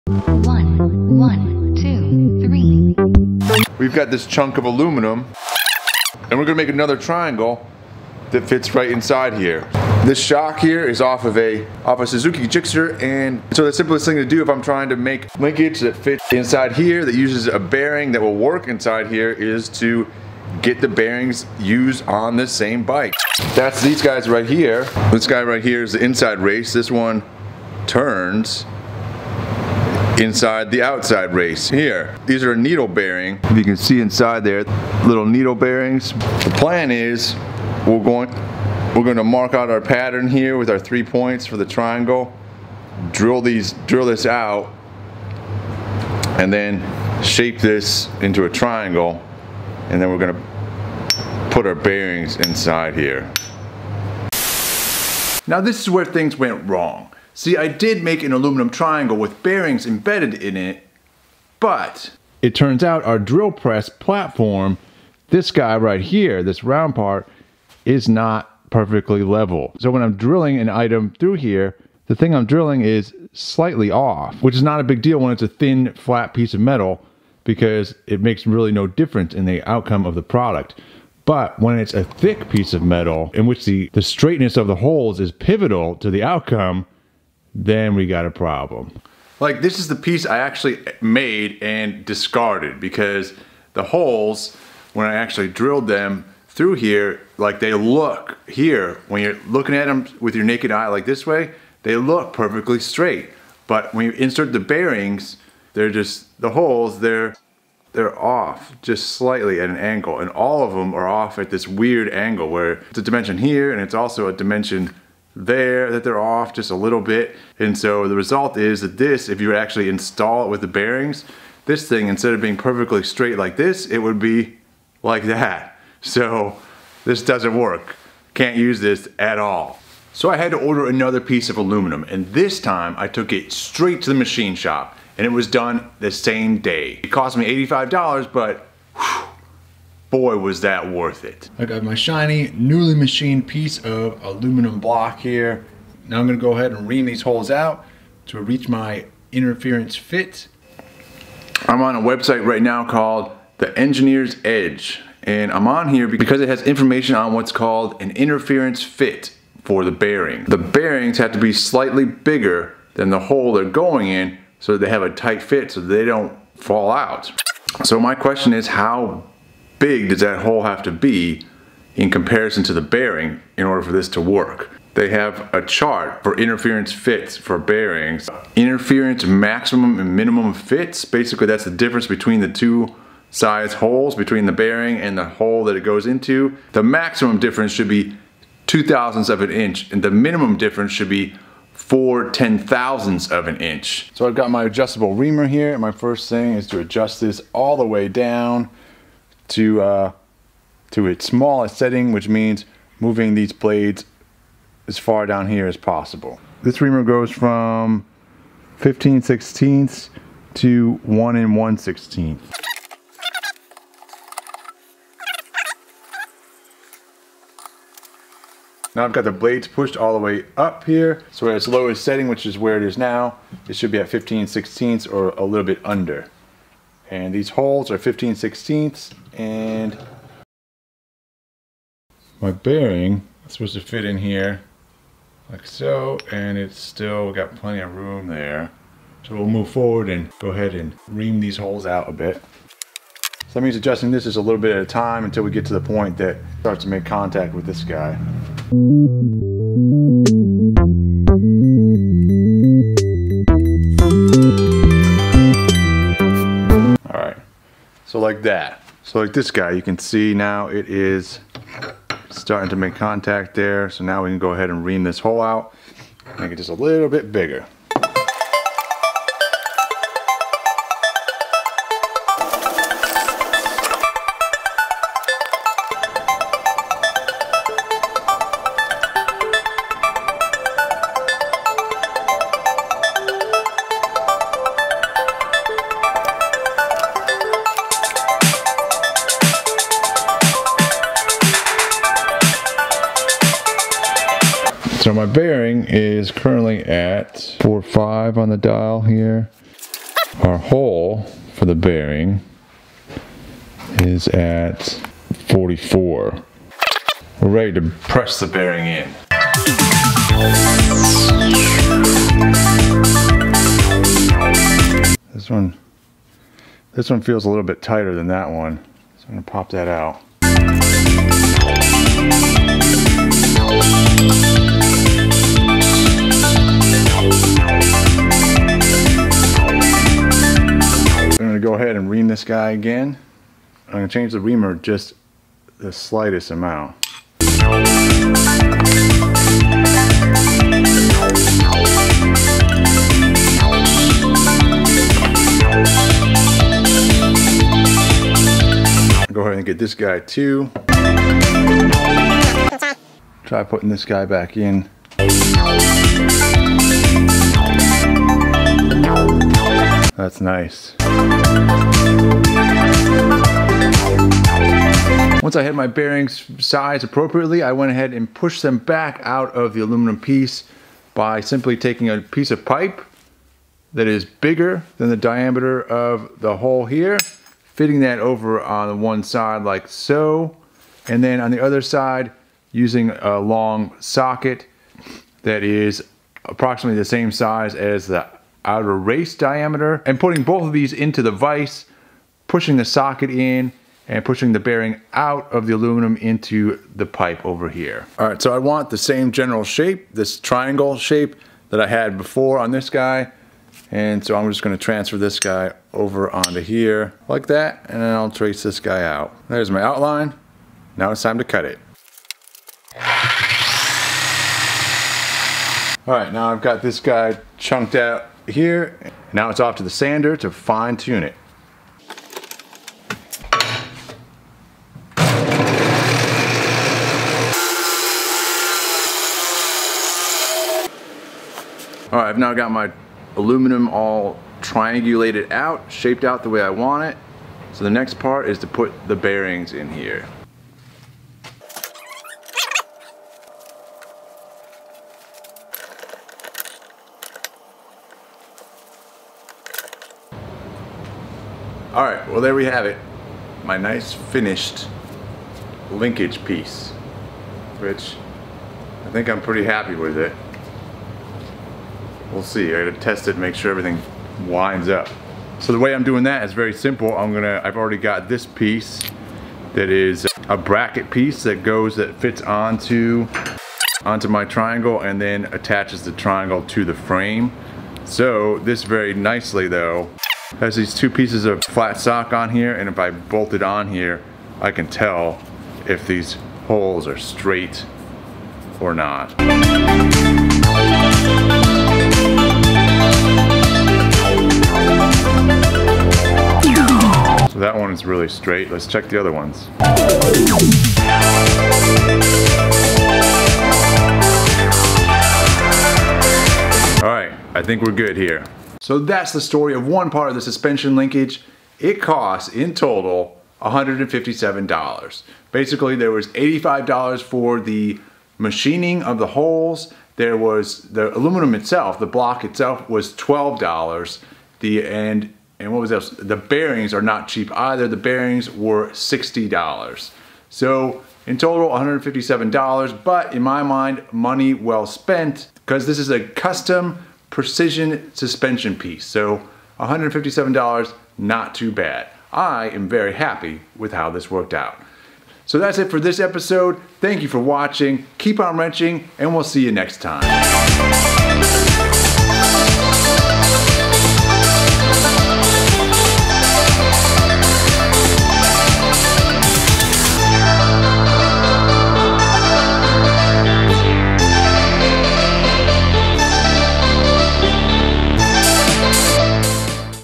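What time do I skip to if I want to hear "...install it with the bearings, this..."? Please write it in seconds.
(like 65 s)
119 s.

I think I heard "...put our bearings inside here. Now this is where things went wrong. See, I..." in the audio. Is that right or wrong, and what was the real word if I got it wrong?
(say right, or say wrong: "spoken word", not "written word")
right.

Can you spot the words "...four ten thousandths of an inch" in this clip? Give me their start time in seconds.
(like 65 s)
191 s.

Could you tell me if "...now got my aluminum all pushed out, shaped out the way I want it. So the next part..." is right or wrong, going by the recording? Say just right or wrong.
wrong.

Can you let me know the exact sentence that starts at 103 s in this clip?
But when you insert the bearings, they're just, the holes, they're, they're off just slightly at an angle.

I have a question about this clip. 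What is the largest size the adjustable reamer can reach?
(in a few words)
1 1/16 inch.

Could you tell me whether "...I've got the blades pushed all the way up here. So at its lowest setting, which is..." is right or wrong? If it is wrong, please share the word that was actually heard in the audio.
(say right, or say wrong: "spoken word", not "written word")
right.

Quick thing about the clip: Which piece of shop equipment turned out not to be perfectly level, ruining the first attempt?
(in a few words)
Drill press platform.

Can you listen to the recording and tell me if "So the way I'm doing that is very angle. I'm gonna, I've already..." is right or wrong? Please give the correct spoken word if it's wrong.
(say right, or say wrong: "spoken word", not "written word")
wrong: "simple", not "angle".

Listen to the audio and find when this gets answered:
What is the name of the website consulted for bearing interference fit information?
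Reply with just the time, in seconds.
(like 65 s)
153 s.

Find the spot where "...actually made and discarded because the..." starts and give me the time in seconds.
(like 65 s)
90 s.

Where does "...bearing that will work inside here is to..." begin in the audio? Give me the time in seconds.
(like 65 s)
17 s.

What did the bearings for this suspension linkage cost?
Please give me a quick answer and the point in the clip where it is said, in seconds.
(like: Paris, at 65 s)
$60, at 528 s.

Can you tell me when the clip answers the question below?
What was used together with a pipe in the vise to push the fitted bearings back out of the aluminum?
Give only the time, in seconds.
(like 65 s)
383 s.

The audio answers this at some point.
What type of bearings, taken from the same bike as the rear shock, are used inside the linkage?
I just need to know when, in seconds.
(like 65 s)
32 s.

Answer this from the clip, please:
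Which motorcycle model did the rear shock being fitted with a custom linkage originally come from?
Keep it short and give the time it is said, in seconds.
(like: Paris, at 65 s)
Suzuki Gixxer, at 12 s.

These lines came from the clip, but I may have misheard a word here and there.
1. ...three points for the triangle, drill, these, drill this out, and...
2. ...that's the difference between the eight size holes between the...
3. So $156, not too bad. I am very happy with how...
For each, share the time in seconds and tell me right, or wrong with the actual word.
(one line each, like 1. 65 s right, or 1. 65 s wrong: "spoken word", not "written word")
1. 40 s right
2. 181 s wrong: "two", not "eight"
3. 539 s wrong: "157", not "156".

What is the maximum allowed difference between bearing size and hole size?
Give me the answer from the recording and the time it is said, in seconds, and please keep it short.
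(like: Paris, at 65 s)
2 thousandths of an inch, at 188 s.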